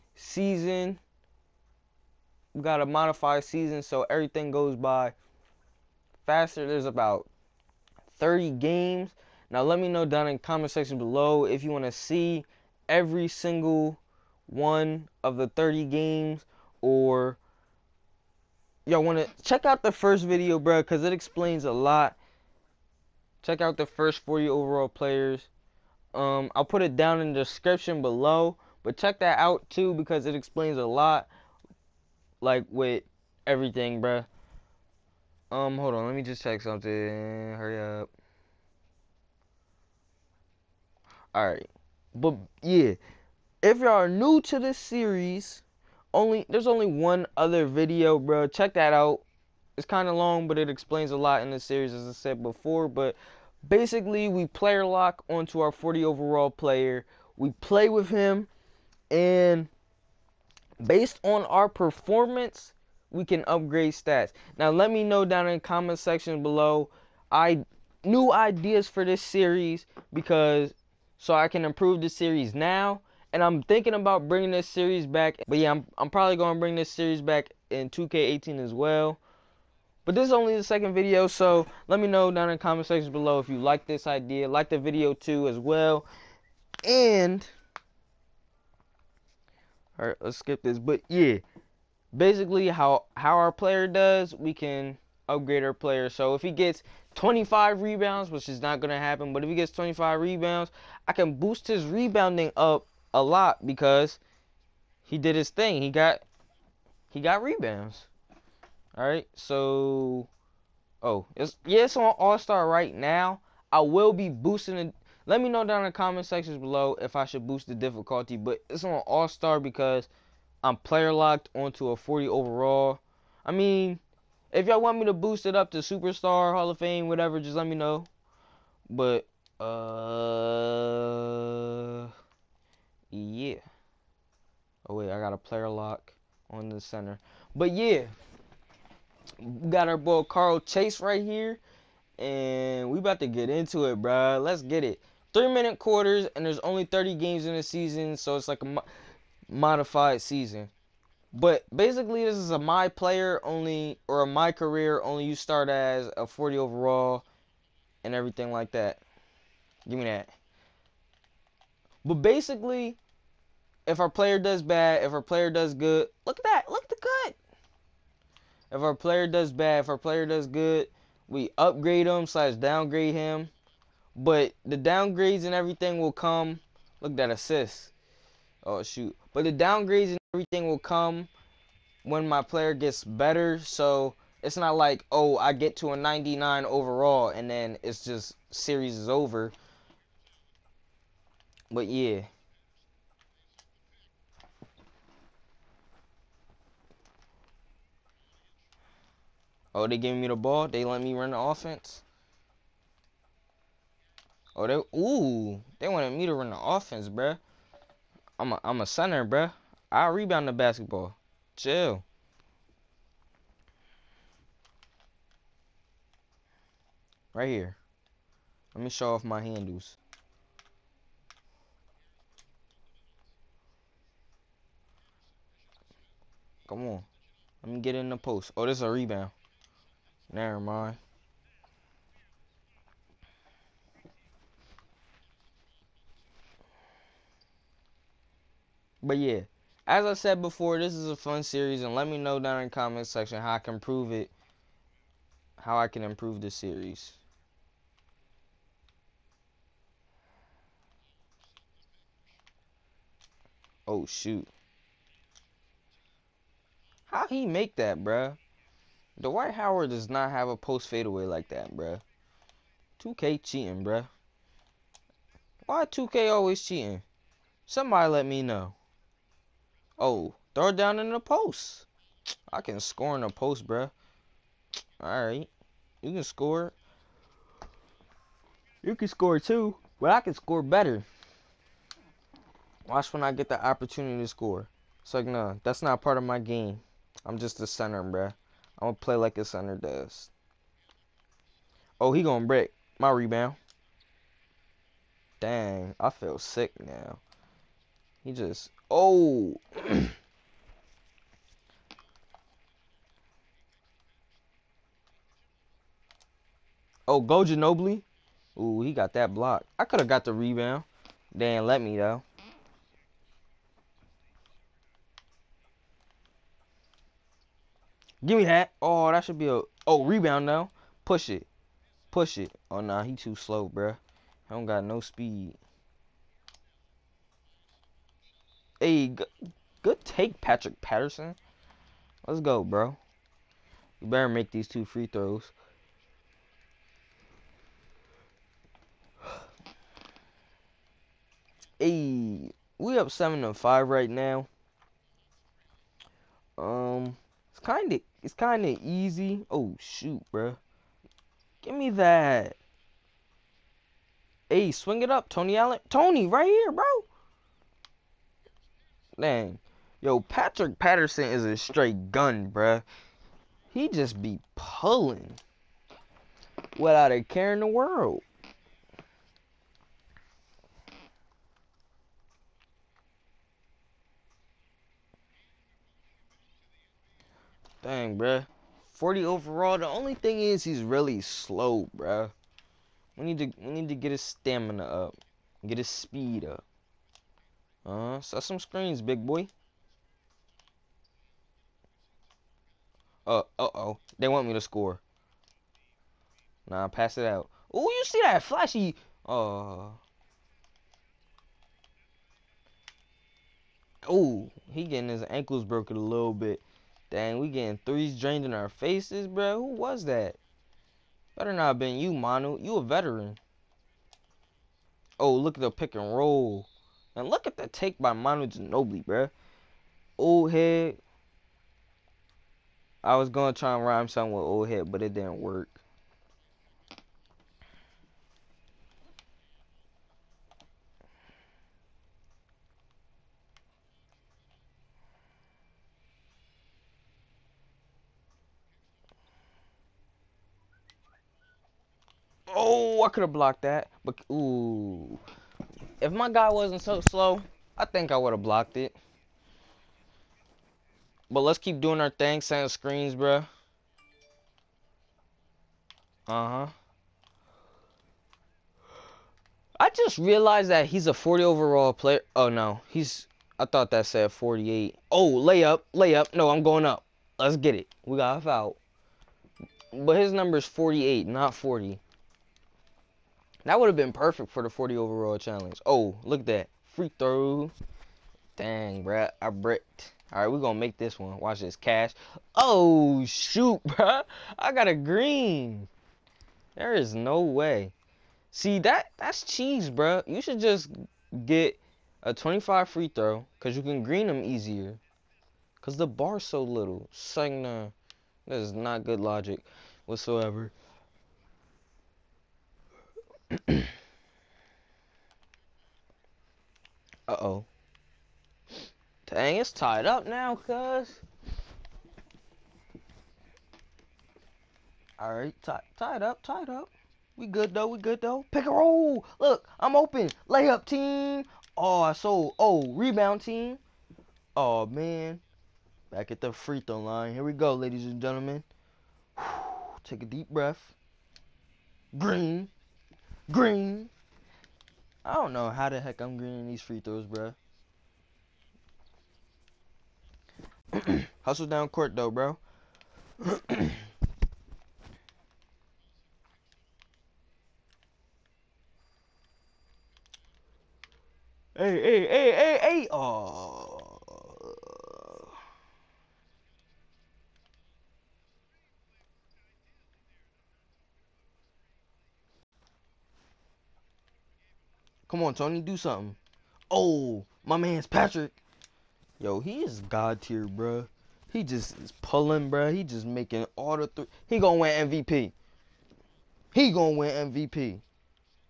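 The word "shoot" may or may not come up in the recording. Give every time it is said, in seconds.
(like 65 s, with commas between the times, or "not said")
178 s, 254 s, 349 s, 483 s.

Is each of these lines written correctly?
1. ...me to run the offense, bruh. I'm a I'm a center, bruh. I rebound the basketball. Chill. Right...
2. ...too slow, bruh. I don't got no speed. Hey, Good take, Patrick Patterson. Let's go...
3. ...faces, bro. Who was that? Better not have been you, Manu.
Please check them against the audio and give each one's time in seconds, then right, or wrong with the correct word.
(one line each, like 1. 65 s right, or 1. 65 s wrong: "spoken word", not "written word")
1. 206 s right
2. 323 s right
3. 408 s right.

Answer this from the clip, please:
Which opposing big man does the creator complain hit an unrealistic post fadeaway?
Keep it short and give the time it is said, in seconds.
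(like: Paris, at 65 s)
Dwight Howard, at 259 s.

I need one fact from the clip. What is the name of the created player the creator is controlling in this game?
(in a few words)
Carl Chase.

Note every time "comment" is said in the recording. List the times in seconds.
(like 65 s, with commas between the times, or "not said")
10 s, 65 s, 82 s, 115 s, 242 s.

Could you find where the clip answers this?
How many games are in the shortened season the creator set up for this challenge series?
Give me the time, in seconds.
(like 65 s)
6 s.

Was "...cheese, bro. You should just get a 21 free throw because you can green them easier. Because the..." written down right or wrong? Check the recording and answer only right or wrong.
wrong.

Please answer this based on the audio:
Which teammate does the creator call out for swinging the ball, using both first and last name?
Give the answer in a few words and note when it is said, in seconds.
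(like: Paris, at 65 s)
Tony Allen, at 355 s.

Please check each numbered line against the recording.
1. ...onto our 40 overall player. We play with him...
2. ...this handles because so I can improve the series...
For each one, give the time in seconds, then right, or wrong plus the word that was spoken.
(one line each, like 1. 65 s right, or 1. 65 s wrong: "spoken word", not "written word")
1. 55 s right
2. 69 s wrong: "series", not "handles".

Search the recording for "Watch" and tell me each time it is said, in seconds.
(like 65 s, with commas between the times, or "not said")
282 s, 481 s.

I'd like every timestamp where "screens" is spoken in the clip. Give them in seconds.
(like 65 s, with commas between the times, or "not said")
388 s, 452 s.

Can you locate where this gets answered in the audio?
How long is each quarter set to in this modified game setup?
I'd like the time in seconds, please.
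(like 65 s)
145 s.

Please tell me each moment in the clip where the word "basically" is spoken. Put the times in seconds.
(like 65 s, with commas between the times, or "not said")
53 s, 92 s, 151 s, 162 s.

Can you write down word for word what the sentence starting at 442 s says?
Oh, I could have blocked that, but ooh, if my guy wasn't so slow, I think I would have blocked it.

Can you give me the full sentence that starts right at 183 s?
So it's not like, oh, I get to a 99 overall and then it's just series is over.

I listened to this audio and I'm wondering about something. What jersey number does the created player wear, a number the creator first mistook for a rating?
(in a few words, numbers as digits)
48.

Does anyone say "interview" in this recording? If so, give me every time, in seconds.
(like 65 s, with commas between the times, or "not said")
not said.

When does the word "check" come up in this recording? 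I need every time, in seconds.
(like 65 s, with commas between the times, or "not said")
19 s, 23 s, 28 s, 36 s, 48 s.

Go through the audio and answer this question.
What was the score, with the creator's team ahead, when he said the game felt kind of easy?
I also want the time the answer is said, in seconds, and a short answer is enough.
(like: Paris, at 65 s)
7 to 5, at 343 s.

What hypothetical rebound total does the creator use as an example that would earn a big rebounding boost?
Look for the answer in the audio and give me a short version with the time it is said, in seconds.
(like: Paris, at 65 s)
25, at 97 s.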